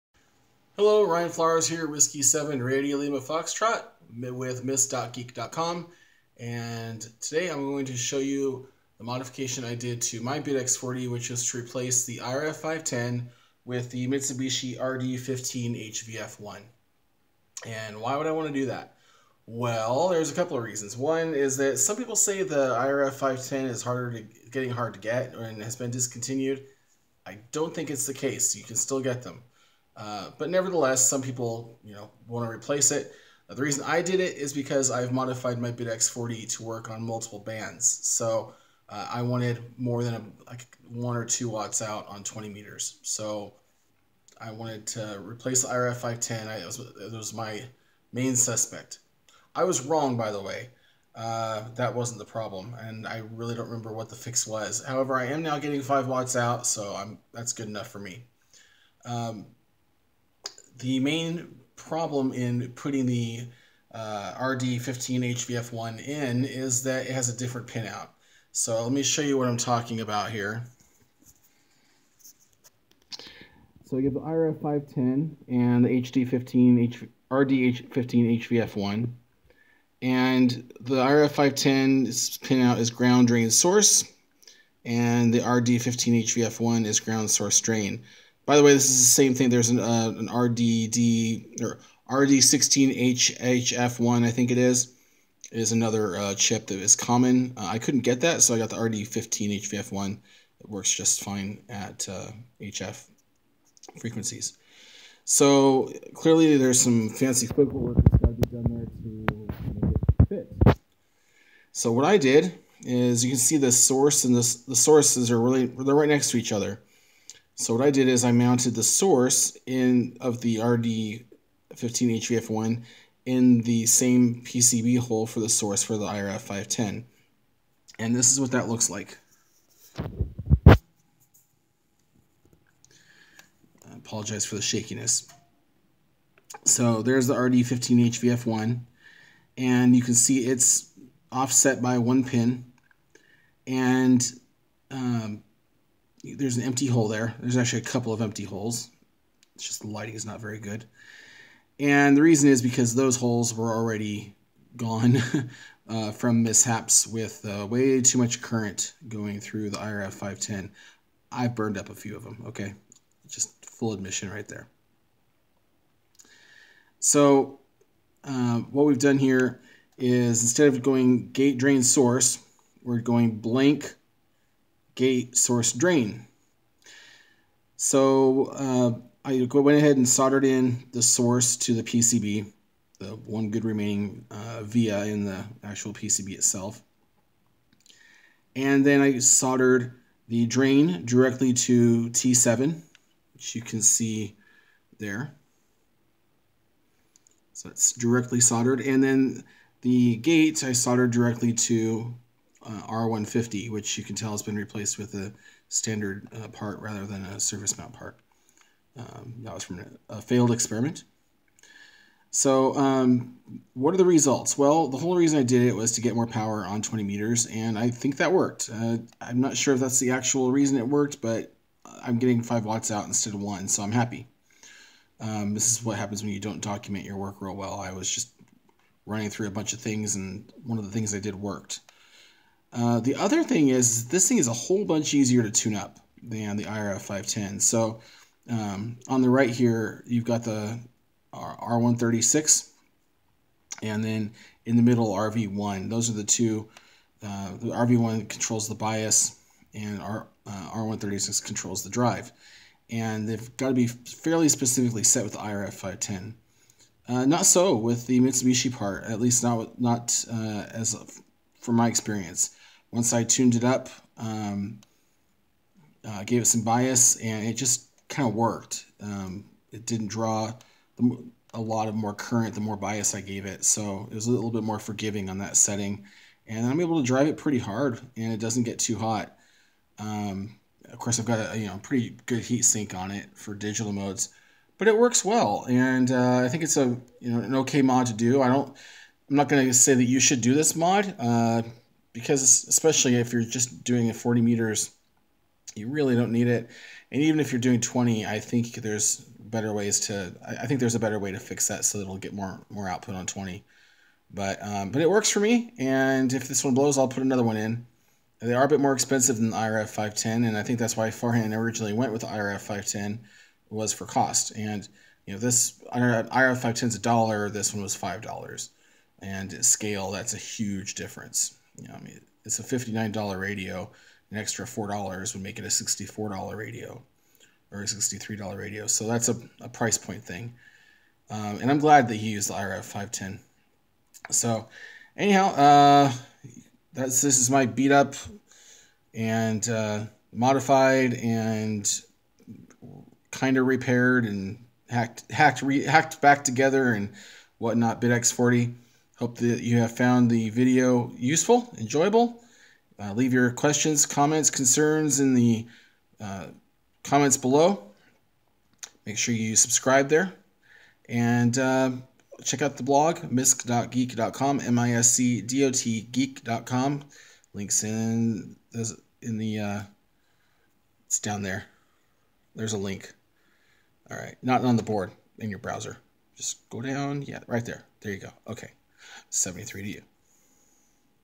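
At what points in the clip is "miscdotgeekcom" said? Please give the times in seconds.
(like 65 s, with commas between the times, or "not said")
4 s, 363 s.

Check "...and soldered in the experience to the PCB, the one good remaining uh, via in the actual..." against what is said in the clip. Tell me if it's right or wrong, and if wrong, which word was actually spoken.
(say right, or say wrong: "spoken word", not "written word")
wrong: "source", not "experience".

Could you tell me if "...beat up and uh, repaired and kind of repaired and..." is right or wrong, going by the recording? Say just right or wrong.
wrong.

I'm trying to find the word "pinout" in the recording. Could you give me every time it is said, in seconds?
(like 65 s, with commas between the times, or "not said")
67 s, 82 s.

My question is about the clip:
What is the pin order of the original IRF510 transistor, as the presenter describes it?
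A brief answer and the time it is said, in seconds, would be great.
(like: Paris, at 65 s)
ground drain source, at 82 s.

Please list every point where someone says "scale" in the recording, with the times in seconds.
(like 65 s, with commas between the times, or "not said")
319 s.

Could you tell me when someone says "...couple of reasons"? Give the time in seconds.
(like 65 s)
20 s.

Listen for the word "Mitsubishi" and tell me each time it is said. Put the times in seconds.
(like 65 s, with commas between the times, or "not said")
14 s, 258 s.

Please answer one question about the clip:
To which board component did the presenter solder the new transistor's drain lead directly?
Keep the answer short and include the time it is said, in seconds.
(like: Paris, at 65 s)
T7, at 192 s.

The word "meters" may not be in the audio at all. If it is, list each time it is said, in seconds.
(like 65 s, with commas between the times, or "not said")
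42 s, 217 s, 294 s.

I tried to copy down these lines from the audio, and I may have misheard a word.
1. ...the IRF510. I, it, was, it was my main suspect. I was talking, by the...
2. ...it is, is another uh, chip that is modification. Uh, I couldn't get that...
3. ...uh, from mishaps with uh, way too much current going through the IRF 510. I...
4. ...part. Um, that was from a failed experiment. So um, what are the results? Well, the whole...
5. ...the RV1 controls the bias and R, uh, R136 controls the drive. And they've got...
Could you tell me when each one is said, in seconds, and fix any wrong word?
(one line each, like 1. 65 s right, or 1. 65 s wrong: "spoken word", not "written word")
1. 45 s wrong: "wrong", not "talking"
2. 94 s wrong: "common", not "modification"
3. 155 s right
4. 207 s right
5. 247 s right.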